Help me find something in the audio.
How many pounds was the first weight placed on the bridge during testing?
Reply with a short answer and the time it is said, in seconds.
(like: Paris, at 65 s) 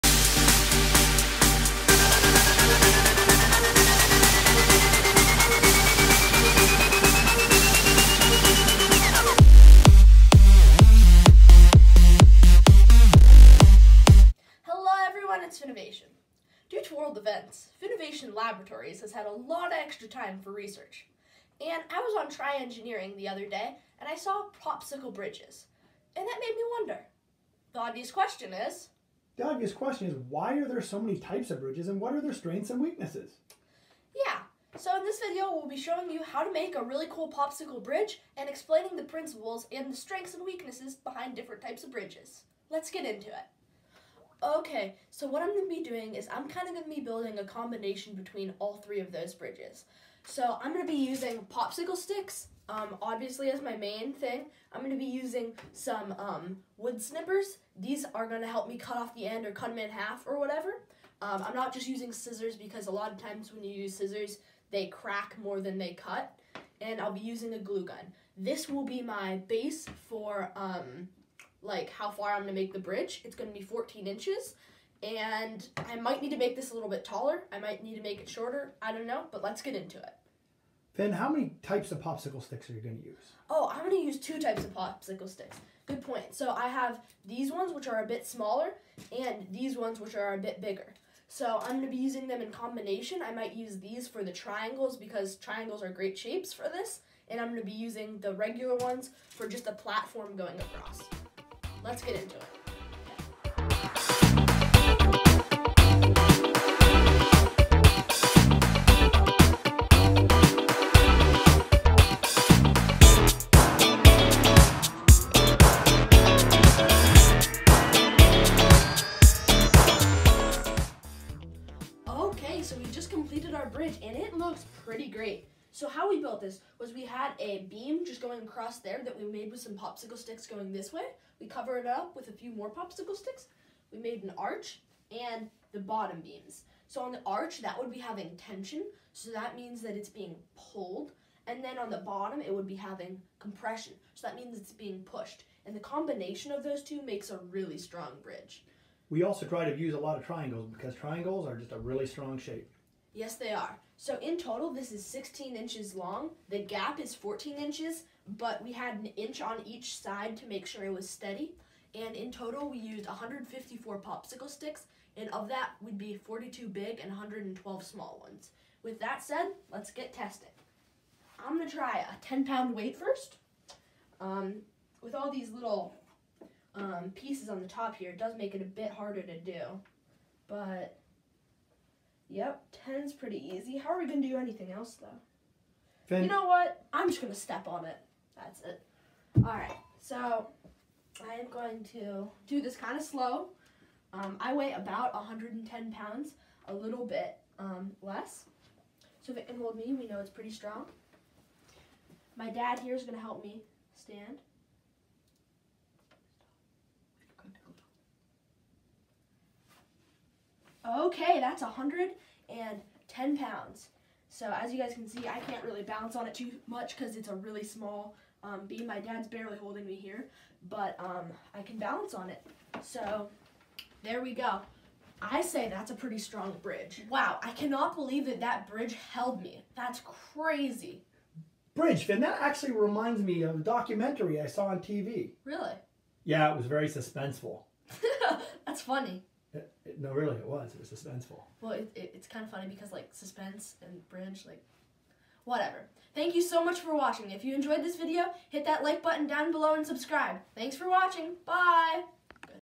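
10, at 172 s.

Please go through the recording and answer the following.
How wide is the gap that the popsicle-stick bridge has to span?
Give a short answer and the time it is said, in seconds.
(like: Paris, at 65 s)
14 inches, at 156 s.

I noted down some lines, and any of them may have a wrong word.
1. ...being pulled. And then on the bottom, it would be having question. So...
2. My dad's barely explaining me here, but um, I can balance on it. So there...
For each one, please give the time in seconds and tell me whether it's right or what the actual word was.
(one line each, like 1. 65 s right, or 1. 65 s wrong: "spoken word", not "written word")
1. 140 s wrong: "compression", not "question"
2. 218 s wrong: "holding", not "explaining".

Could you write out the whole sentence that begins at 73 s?
It's gonna be 14 inches and I might need to make this a little bit taller.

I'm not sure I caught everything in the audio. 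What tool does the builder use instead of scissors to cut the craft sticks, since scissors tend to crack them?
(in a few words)
wood snippers.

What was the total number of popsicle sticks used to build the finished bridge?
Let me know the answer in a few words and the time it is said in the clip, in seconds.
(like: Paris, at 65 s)
154, at 163 s.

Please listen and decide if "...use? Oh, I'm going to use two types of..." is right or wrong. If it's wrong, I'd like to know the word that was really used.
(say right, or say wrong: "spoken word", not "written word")
right.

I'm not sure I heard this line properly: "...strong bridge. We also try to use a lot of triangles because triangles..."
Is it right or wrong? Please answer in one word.
right.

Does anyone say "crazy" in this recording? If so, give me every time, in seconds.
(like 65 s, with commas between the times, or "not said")
230 s.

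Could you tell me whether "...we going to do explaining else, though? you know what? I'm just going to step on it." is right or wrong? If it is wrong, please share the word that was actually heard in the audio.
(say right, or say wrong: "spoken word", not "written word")
wrong: "anything", not "explaining".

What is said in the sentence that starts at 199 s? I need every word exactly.
So if it can hold me, we know it's pretty strong.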